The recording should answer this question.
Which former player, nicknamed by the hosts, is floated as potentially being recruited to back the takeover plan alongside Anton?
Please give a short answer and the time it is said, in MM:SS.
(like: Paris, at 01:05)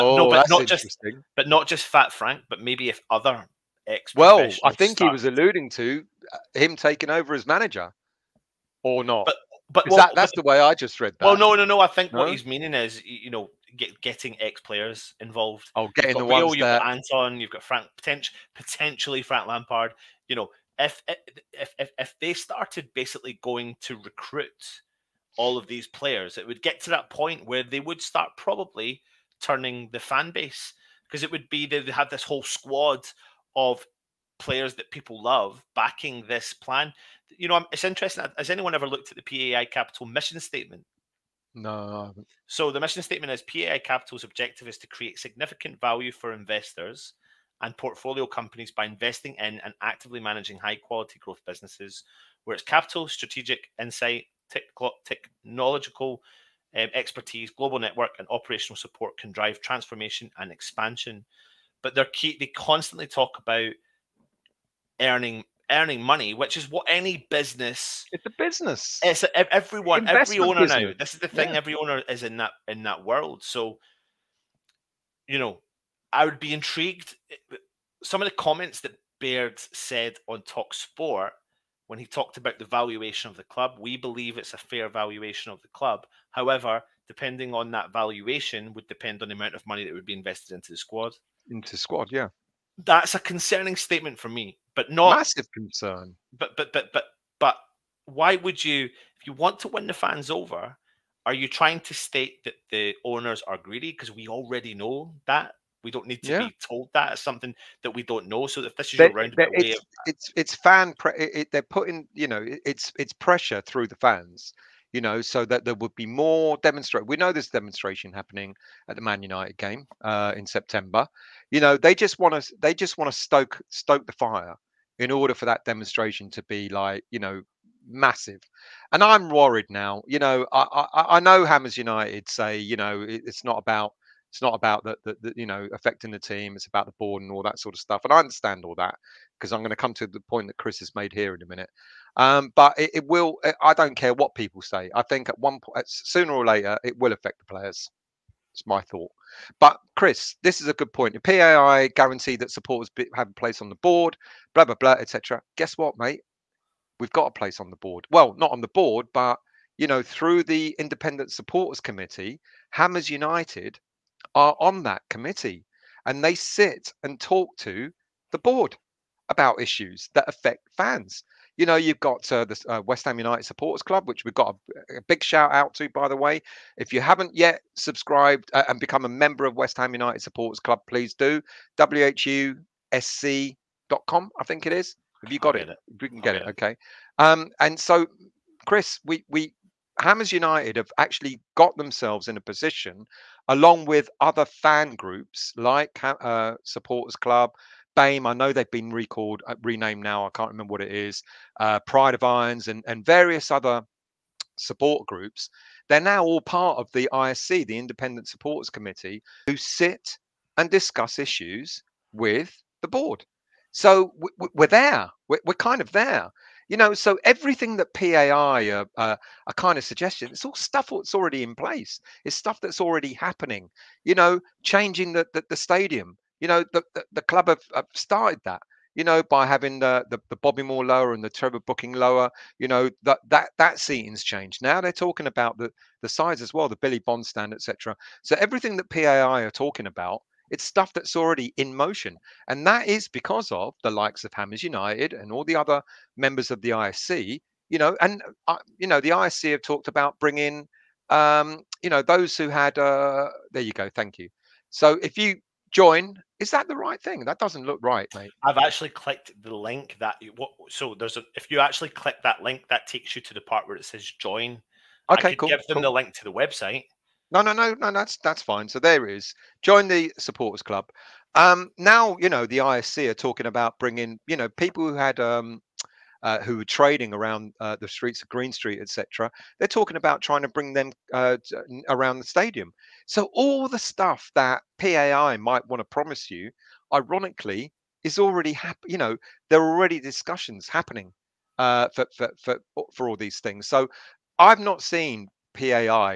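Frank Lampard, at 00:19.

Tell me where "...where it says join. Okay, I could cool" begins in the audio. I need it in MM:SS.
04:23.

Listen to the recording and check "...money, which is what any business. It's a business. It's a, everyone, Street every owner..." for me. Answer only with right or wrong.
wrong.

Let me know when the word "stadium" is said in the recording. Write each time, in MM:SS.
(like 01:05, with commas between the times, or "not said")
03:45, 04:42.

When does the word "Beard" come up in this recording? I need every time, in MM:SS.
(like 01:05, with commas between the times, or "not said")
01:19.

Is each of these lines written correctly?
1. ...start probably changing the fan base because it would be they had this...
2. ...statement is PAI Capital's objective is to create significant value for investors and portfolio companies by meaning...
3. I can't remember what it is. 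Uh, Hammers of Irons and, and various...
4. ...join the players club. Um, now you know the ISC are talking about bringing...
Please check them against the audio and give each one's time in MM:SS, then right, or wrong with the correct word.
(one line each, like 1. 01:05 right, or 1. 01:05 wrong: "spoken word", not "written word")
1. 00:28 wrong: "turning", not "changing"
2. 00:43 wrong: "investing", not "meaning"
3. 03:20 wrong: "Pride", not "Hammers"
4. 04:29 wrong: "supporters", not "players".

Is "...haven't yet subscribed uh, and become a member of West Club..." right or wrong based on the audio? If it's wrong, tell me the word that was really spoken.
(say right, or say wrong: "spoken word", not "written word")
wrong: "Ham", not "Club".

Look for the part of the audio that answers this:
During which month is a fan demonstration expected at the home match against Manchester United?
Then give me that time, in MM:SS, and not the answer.
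02:00.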